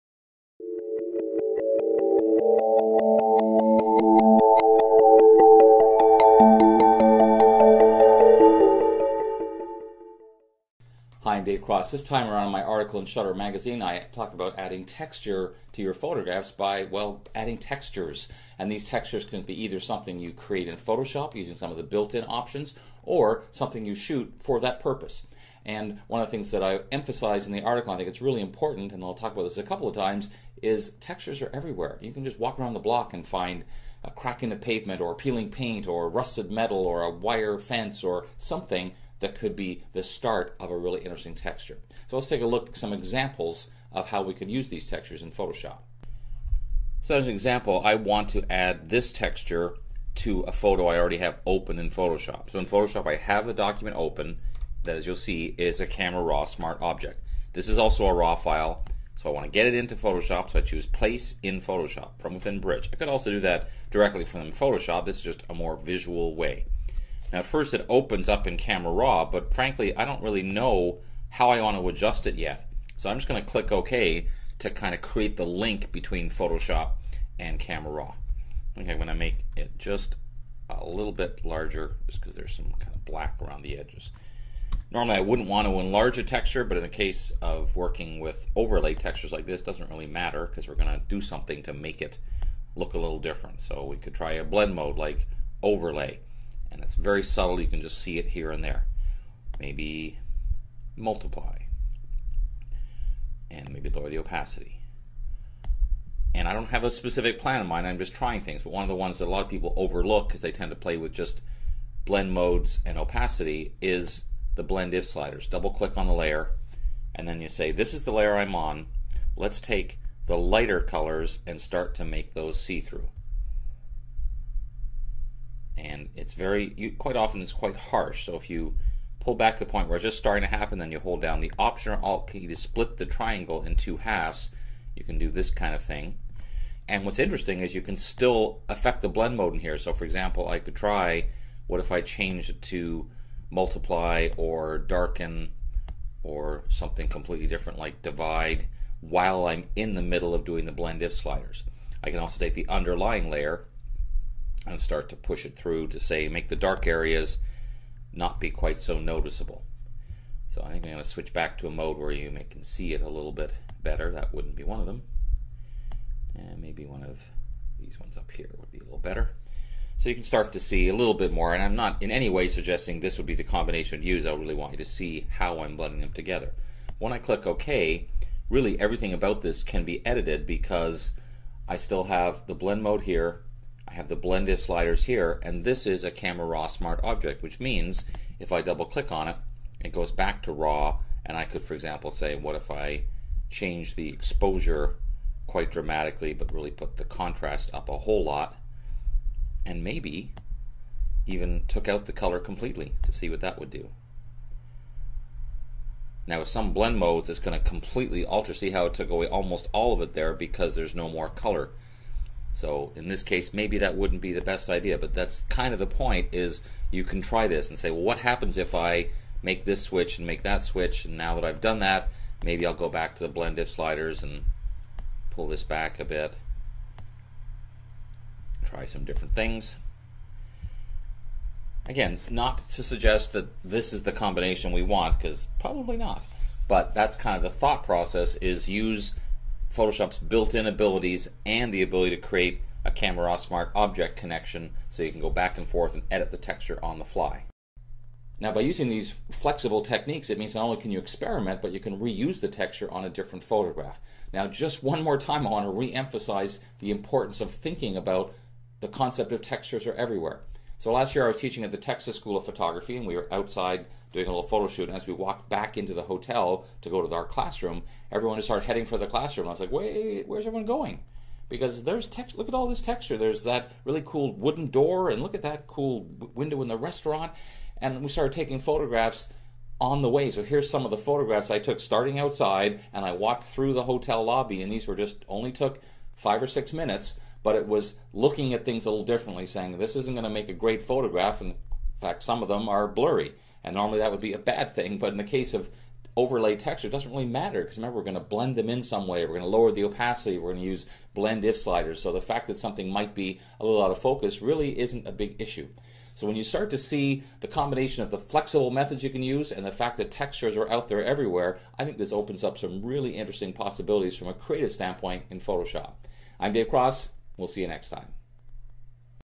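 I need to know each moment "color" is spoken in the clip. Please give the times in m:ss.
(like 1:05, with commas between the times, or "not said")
2:00, 3:22, 3:31.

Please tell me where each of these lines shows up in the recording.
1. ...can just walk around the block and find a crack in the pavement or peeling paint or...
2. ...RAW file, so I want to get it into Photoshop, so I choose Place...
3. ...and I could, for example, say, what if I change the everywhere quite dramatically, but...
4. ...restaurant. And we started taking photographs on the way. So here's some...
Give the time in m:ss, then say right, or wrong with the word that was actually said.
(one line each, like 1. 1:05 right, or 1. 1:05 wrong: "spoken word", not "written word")
1. 0:32 right
2. 0:58 right
3. 3:11 wrong: "exposure", not "everywhere"
4. 4:36 right.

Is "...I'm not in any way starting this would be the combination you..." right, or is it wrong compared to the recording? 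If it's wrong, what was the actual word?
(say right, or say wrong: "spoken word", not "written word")
wrong: "suggesting", not "starting".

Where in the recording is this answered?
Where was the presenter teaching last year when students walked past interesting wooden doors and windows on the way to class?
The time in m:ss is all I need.
4:21.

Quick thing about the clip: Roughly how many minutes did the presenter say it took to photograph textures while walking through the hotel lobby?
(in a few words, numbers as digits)
5 or 6.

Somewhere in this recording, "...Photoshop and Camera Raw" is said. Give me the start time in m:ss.
1:16.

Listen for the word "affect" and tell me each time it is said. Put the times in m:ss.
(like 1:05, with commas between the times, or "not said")
2:18.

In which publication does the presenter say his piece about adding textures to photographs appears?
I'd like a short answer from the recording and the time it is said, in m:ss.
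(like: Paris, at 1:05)
Shutter Magazine, at 0:13.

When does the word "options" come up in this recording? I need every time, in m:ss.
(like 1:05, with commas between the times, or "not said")
0:22, 2:11.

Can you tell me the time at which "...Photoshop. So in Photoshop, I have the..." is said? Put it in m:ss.
0:51.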